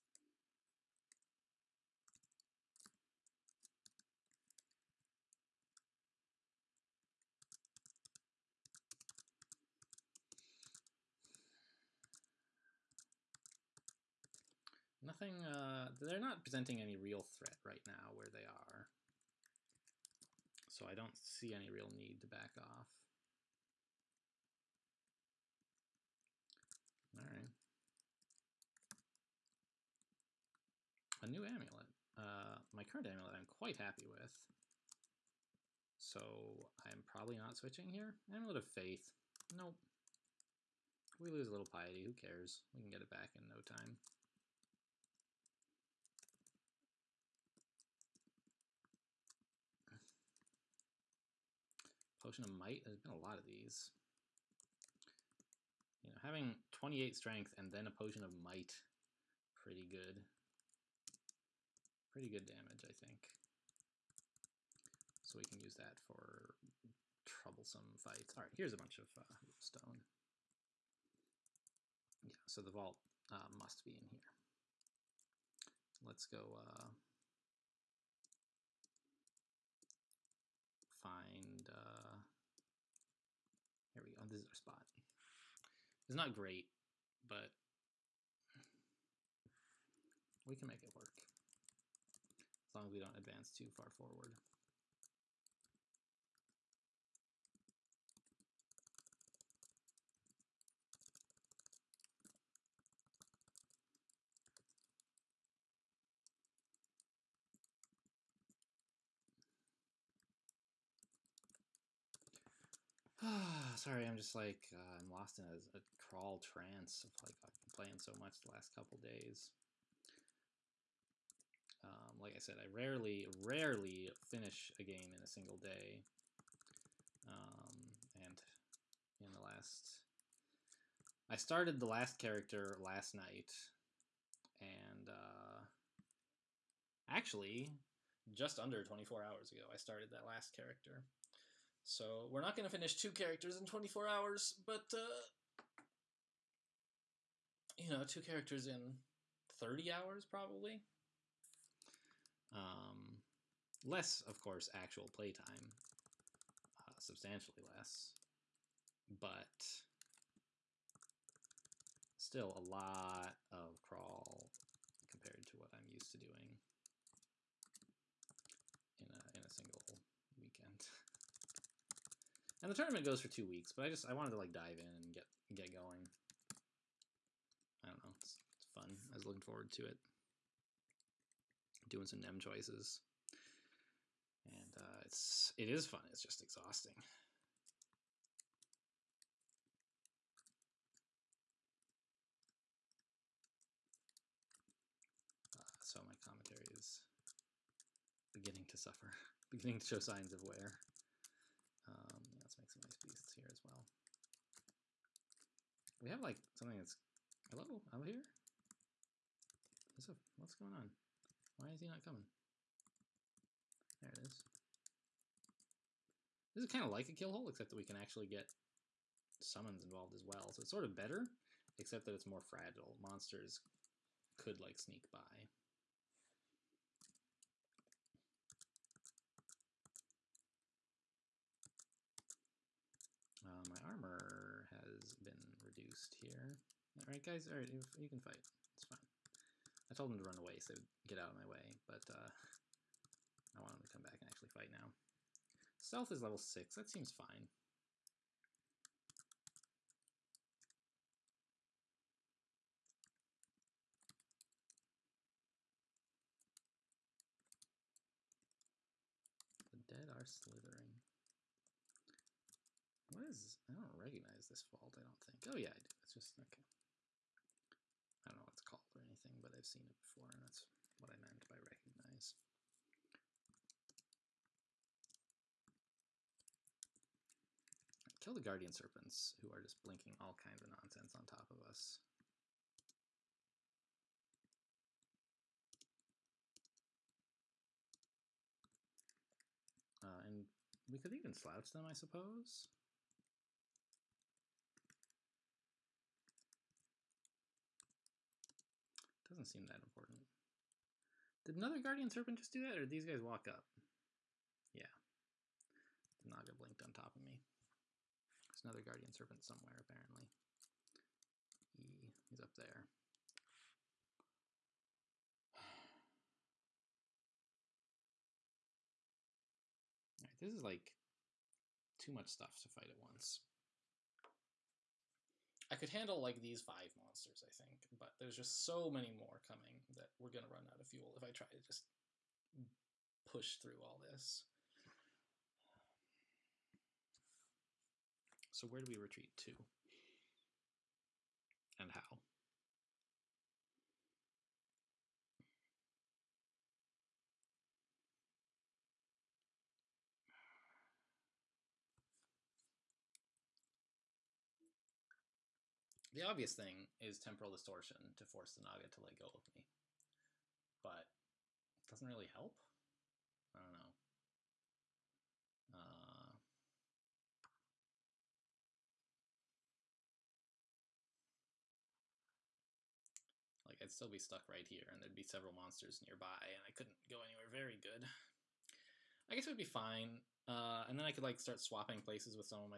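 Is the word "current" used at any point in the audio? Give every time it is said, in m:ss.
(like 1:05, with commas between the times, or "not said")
0:32.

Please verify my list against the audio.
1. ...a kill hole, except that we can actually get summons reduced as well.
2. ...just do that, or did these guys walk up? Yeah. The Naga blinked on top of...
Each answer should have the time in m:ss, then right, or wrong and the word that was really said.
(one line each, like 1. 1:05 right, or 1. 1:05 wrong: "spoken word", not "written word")
1. 3:37 wrong: "involved", not "reduced"
2. 5:02 right.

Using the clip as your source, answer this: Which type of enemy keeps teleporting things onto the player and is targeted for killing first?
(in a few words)
Guardian Serpents.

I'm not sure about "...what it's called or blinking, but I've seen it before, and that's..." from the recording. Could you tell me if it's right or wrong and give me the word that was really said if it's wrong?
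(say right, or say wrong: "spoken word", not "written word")
wrong: "anything", not "blinking".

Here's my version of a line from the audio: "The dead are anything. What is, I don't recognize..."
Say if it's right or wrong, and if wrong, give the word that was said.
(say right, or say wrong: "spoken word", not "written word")
wrong: "slithering", not "anything".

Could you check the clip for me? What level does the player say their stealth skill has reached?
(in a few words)
6.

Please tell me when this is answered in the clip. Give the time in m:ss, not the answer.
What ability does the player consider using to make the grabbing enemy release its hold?
5:57.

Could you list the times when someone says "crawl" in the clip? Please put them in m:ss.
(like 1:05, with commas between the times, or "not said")
1:55, 2:43.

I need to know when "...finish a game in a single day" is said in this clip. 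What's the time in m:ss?
2:04.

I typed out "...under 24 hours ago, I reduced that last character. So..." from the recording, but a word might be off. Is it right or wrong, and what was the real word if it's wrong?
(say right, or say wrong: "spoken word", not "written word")
wrong: "started", not "reduced".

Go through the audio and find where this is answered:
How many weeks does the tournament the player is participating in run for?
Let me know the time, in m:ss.
2:53.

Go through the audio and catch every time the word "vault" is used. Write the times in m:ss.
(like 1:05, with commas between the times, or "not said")
1:12, 4:24.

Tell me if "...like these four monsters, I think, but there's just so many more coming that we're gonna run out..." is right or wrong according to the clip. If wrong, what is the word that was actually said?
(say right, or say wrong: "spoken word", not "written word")
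wrong: "five", not "four".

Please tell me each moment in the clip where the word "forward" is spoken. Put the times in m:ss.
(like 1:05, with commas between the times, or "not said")
1:33, 2:59.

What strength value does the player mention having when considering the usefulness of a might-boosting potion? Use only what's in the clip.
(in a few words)
28.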